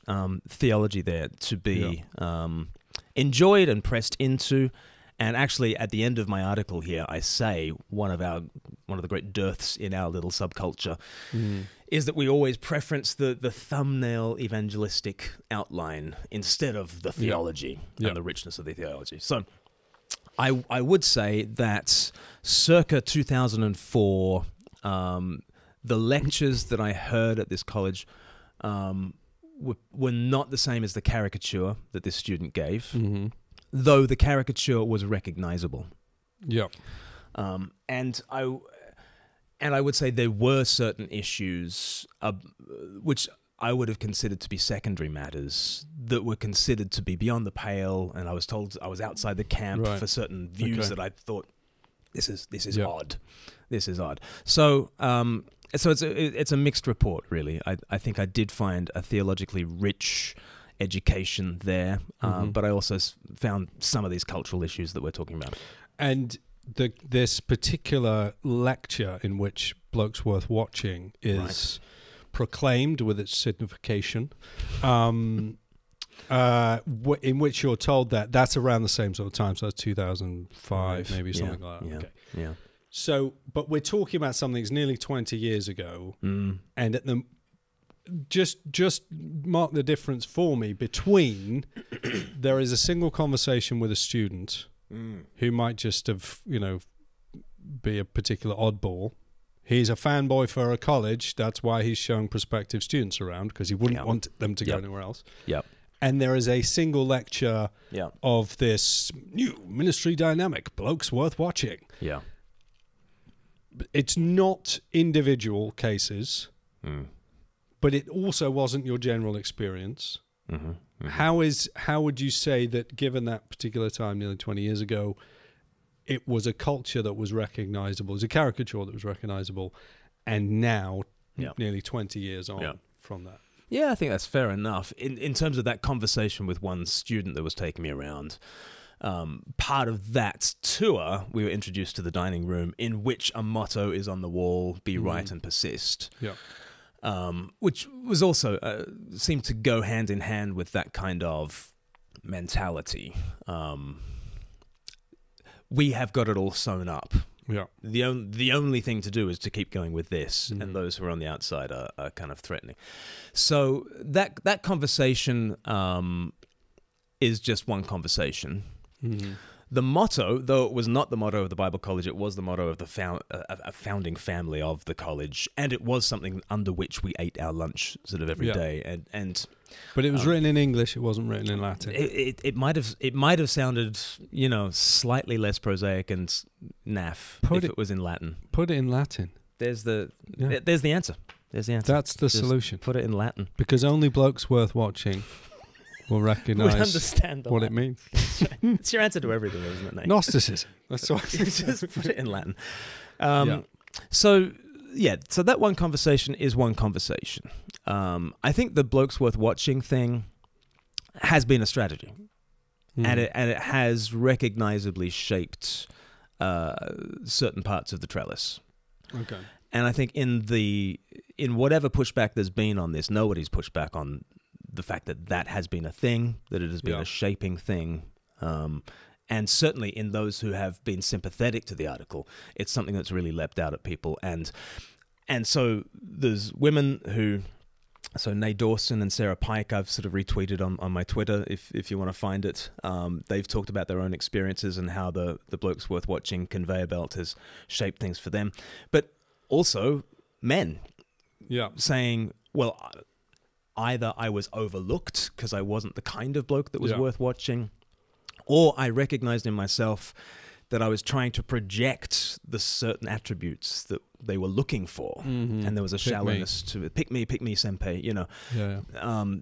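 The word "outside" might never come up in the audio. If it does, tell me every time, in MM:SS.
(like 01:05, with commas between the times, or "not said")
00:49, 02:41.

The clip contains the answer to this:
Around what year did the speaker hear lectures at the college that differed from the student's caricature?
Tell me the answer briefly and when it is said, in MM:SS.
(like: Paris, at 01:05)
2004, at 00:23.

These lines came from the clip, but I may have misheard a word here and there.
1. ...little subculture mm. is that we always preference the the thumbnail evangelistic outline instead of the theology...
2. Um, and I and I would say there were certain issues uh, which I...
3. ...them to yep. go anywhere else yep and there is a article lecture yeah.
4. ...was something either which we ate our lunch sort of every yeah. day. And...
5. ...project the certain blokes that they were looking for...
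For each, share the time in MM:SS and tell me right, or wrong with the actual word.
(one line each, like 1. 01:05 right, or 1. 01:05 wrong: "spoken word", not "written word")
1. 00:10 right
2. 00:37 right
3. 01:44 wrong: "single", not "article"
4. 02:55 wrong: "under", not "either"
5. 04:21 wrong: "attributes", not "blokes".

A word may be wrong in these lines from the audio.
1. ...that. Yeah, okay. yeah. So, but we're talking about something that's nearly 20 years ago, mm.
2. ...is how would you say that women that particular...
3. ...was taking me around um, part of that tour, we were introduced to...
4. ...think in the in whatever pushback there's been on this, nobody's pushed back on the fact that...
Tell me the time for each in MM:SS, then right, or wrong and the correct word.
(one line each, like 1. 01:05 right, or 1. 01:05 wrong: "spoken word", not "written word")
1. 01:21 right
2. 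02:01 wrong: "given", not "women"
3. 02:17 right
4. 03:39 right.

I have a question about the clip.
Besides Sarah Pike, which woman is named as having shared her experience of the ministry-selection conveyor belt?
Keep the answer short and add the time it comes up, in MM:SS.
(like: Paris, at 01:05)
Nay Dawson, at 03:58.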